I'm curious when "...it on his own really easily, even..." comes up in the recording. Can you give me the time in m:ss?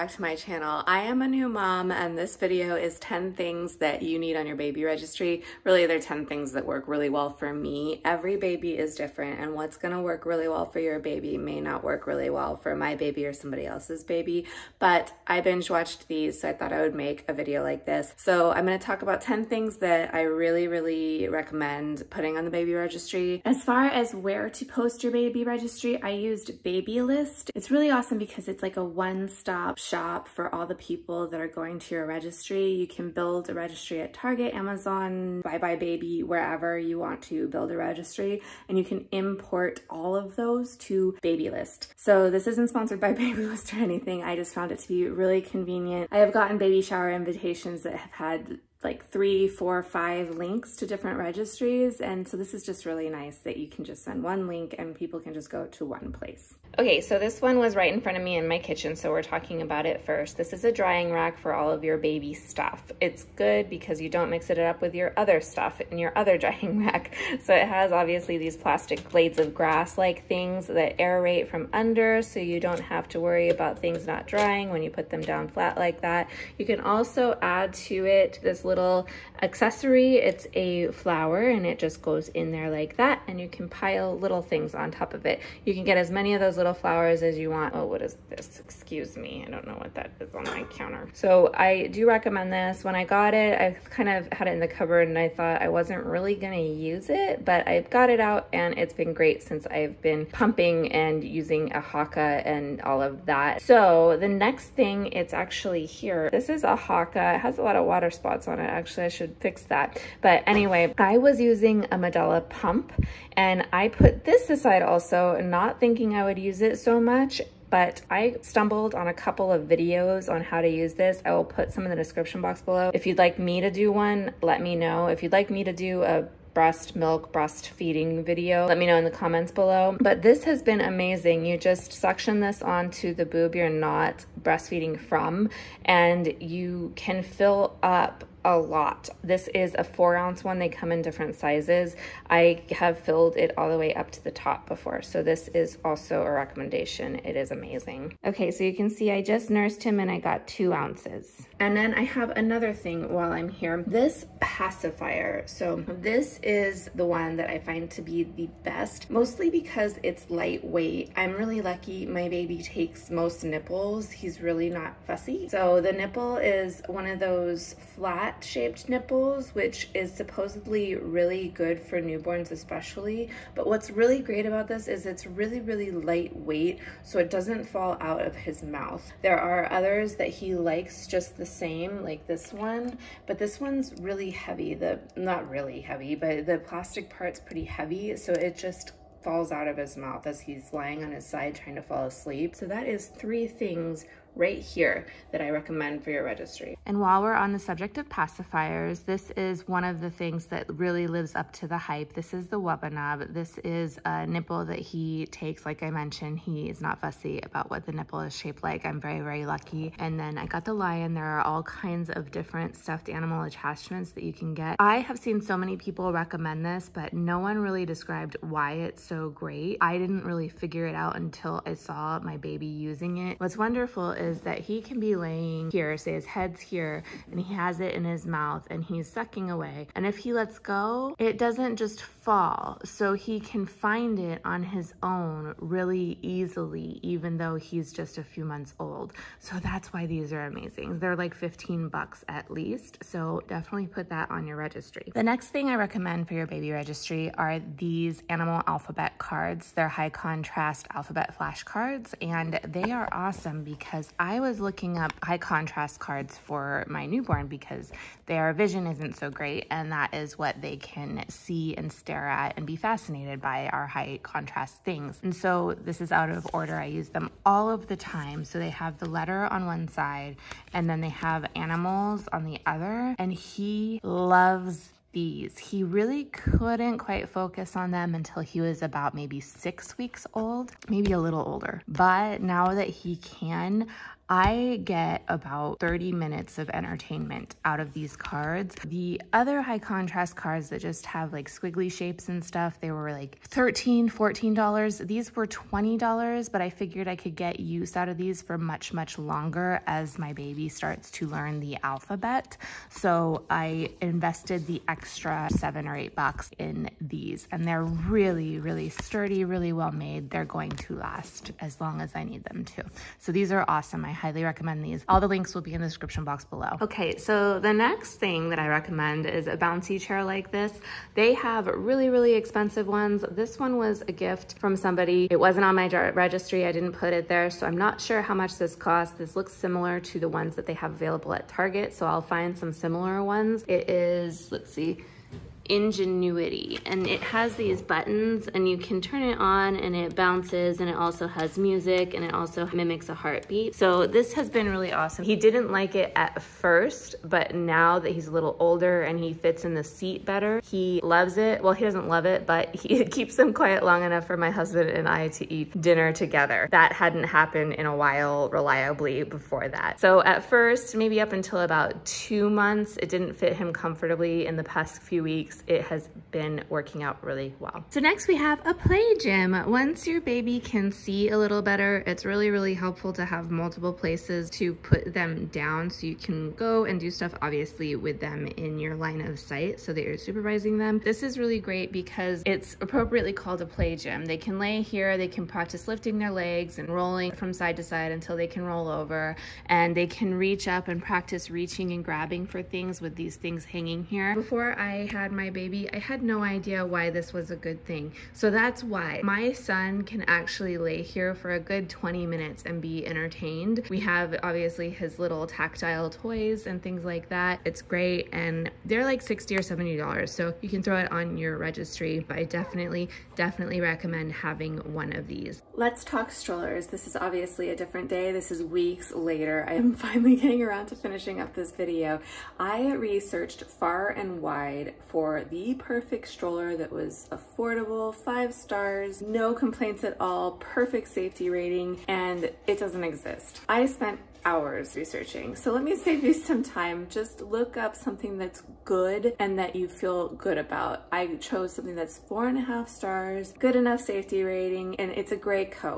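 3:54.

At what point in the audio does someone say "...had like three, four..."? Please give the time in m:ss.
0:48.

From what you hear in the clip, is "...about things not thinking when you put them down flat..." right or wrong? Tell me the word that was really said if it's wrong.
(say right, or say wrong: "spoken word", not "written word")
wrong: "drying", not "thinking".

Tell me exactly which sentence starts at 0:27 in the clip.
It's really awesome because it's like like a one-stop shop for all the people that are going to your registry.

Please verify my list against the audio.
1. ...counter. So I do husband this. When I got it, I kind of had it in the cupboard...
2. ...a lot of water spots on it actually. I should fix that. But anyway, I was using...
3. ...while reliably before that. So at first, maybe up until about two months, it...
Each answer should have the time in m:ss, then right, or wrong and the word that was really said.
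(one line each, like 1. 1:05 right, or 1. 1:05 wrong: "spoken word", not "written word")
1. 1:30 wrong: "recommend", not "husband"
2. 1:47 right
3. 5:57 right.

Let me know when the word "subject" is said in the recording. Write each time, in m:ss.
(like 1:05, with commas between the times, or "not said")
3:17.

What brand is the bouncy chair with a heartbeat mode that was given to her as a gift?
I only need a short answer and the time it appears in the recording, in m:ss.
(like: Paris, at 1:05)
Ingenuity, at 5:35.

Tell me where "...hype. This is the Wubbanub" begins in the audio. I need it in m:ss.
3:21.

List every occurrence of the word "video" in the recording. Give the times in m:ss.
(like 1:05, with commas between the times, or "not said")
0:02, 0:17, 1:59, 2:08, 7:01.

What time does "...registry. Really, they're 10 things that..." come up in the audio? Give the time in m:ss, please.
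0:04.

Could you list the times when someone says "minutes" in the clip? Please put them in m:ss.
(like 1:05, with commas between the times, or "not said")
4:46, 6:42.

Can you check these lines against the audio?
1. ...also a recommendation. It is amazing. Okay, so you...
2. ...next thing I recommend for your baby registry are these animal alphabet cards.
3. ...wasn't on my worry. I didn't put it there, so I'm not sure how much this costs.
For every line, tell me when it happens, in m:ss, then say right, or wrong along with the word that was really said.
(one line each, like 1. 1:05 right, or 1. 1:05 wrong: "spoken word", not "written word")
1. 2:25 right
2. 4:05 right
3. 5:25 wrong: "registry", not "worry".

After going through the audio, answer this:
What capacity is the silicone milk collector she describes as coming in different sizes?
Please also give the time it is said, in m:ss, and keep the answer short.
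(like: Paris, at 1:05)
4 ounces, at 2:19.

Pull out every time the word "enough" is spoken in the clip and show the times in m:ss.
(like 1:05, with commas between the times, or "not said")
5:54, 7:23.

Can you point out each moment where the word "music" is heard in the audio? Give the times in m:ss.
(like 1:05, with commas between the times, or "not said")
5:41.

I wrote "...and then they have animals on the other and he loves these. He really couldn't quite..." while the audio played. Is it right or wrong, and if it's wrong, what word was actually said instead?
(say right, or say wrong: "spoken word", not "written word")
right.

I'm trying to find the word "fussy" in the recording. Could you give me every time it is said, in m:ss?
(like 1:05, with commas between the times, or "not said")
2:45, 3:26.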